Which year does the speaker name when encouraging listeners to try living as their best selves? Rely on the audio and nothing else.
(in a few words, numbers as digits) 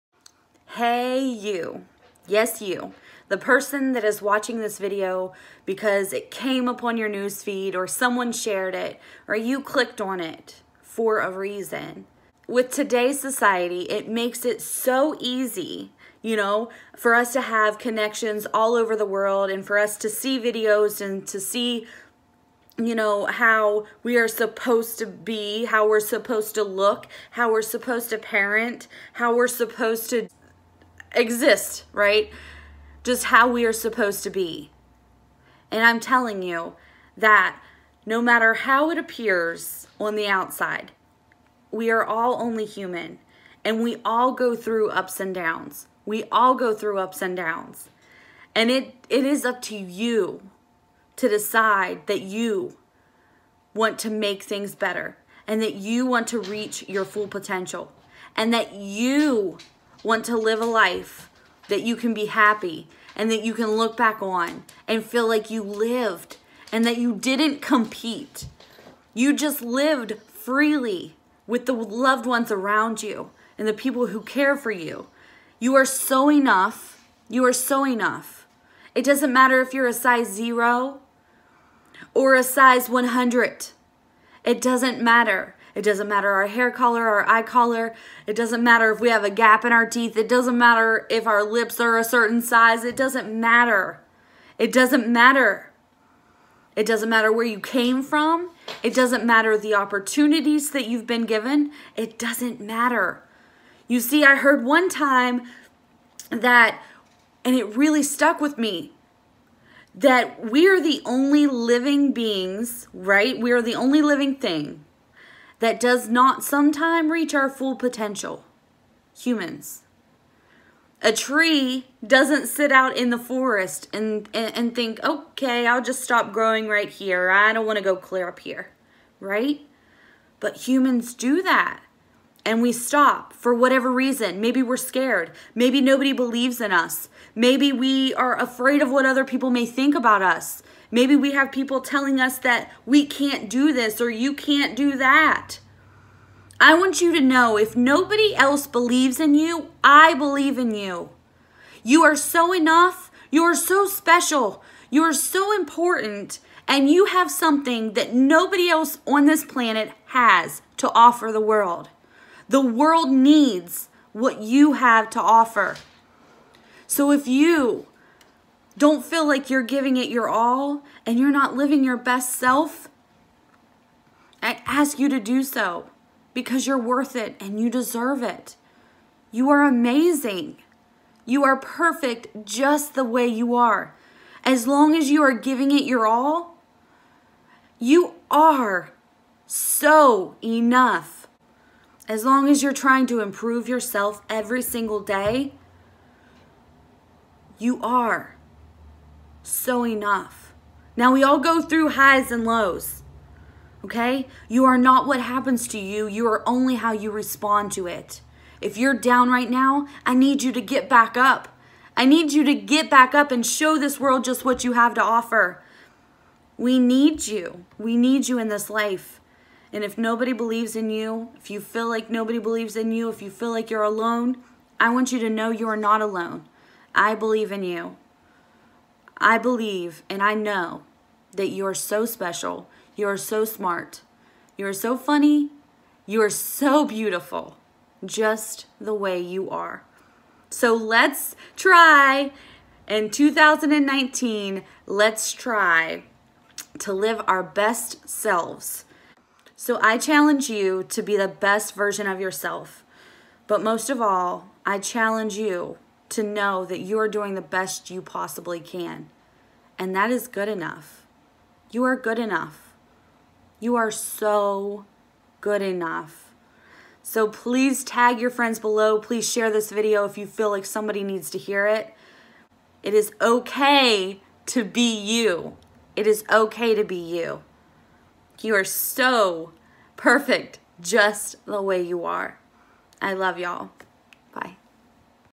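2019.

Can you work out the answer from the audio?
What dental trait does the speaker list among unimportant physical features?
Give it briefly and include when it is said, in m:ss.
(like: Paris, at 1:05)
A gap in our teeth, at 1:29.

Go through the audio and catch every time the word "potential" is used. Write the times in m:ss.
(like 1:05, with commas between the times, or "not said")
0:57, 1:57.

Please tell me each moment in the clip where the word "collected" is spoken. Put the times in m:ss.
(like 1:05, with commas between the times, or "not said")
not said.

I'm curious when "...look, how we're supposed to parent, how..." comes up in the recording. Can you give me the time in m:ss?
0:26.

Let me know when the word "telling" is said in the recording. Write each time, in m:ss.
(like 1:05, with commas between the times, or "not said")
0:35, 2:21.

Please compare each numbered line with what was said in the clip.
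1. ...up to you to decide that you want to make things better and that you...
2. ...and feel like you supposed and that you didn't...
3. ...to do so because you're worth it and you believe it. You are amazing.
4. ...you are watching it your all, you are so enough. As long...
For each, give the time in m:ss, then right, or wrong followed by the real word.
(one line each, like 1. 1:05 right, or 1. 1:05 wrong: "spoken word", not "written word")
1. 0:49 right
2. 1:04 wrong: "lived", not "supposed"
3. 2:55 wrong: "deserve", not "believe"
4. 3:05 wrong: "giving", not "watching".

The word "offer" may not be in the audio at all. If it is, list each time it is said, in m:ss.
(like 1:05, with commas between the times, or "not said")
2:40, 2:45, 3:35.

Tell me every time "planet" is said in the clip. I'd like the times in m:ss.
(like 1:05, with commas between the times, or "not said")
2:39.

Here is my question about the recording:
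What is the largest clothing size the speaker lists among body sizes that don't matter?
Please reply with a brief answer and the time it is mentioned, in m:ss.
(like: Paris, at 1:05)
100, at 1:22.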